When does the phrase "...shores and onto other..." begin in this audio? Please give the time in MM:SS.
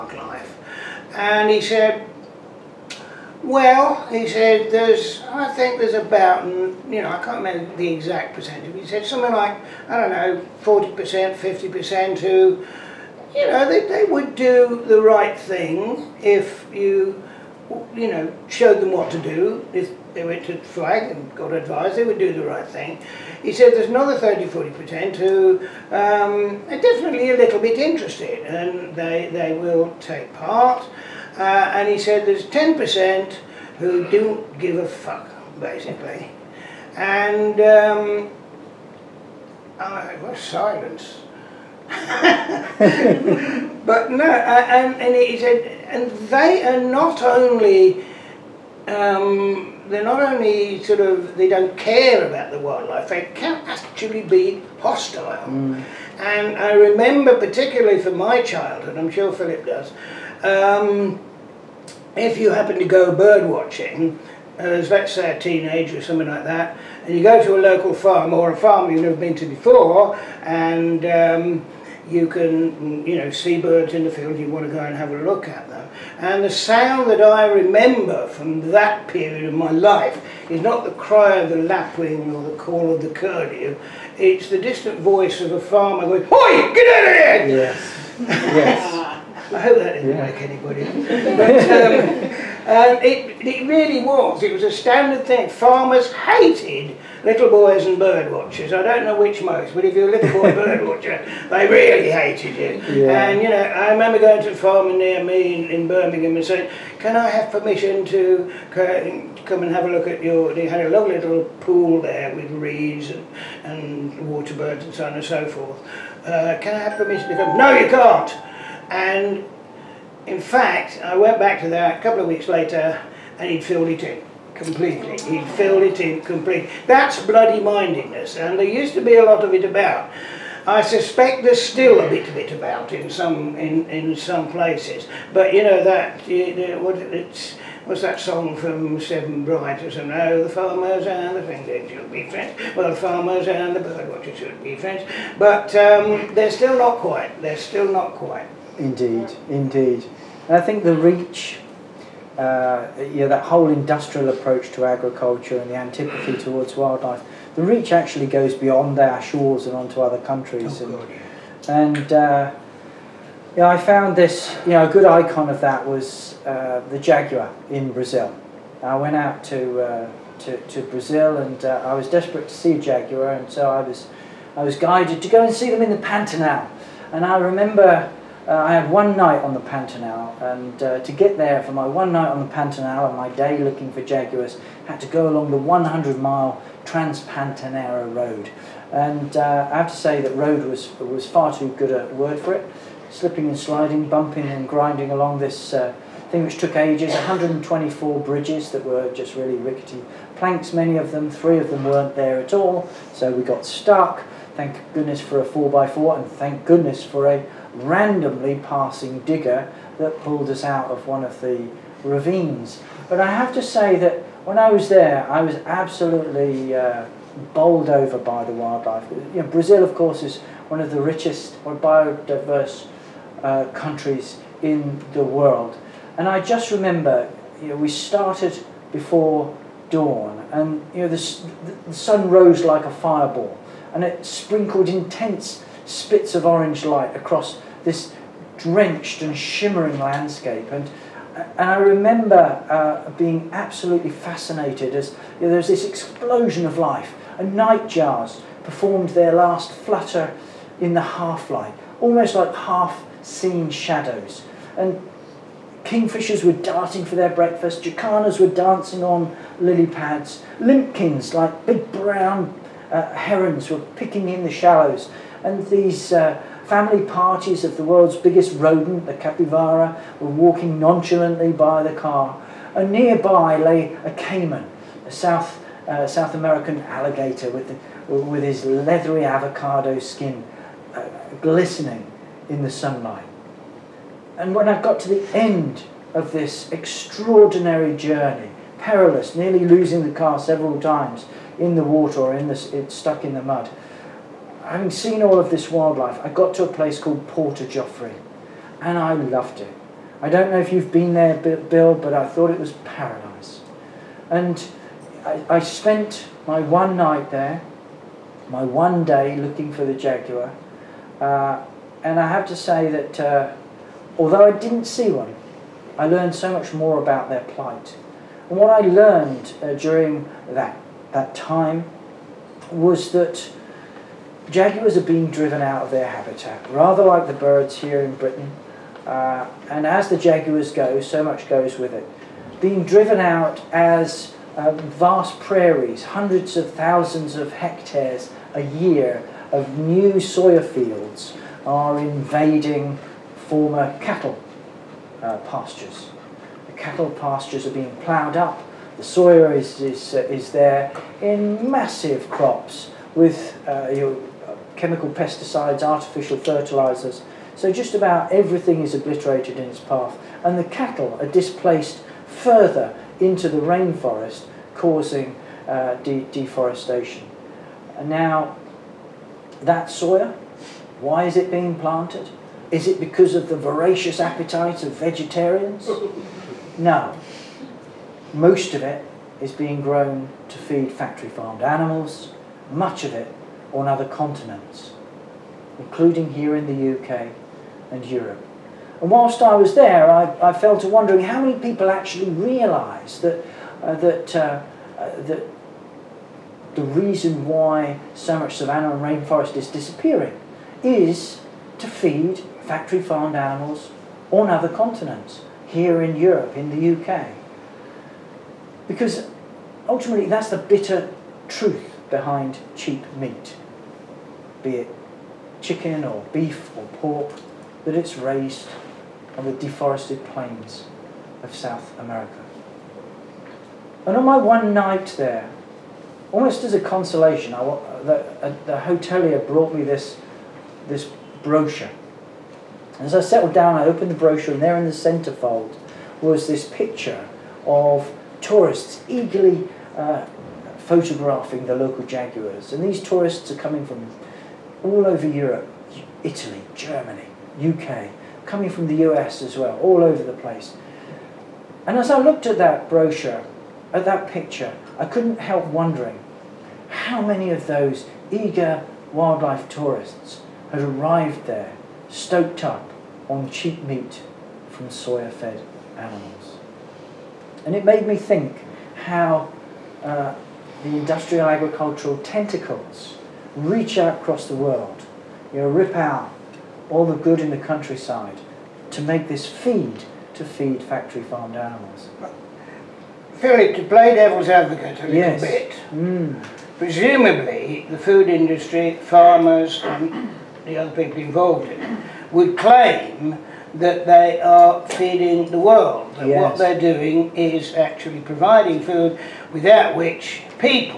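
02:39.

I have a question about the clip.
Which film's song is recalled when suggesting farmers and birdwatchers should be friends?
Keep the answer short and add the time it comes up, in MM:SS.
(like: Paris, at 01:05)
Seven Brides, at 02:19.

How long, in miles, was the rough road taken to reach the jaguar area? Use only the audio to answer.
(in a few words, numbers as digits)
100 miles.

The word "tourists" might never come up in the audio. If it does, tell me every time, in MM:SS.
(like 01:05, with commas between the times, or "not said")
07:18, 07:23, 07:39.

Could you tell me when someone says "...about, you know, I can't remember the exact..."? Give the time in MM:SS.
00:05.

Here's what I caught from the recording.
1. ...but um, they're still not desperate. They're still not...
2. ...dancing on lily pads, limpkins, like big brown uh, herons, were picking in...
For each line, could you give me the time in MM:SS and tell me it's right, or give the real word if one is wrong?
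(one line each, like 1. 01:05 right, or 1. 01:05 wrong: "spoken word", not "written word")
1. 02:25 wrong: "quite", not "desperate"
2. 04:18 right.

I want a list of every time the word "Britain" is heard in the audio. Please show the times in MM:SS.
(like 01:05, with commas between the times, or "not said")
05:28.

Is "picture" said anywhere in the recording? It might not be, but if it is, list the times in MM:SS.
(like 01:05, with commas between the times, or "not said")
07:16, 07:34.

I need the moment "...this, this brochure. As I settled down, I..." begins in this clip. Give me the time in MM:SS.
07:09.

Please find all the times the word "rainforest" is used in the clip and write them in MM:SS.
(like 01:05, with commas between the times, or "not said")
06:03, 06:39.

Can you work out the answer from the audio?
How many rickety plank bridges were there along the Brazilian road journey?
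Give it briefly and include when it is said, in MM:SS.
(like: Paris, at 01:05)
124, at 03:17.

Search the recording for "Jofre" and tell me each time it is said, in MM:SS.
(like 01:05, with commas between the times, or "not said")
04:57.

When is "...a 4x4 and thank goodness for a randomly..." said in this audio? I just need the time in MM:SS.
03:25.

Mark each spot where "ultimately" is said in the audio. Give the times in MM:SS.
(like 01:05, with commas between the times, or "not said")
06:49.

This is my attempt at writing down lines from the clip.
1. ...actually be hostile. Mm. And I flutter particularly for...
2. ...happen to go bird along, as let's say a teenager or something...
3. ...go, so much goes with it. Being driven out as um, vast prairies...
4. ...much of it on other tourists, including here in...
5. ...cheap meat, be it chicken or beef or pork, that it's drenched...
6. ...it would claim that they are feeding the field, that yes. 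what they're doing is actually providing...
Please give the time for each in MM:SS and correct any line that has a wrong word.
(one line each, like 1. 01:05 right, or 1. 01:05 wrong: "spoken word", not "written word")
1. 00:53 wrong: "remember", not "flutter"
2. 01:02 wrong: "watching", not "along"
3. 05:30 right
4. 06:22 wrong: "continents", not "tourists"
5. 06:52 wrong: "raised", not "drenched"
6. 08:11 wrong: "world", not "field".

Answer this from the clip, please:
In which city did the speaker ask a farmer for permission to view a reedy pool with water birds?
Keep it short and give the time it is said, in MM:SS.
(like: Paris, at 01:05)
Birmingham, at 01:45.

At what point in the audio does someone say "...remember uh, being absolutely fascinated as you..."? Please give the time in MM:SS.
04:01.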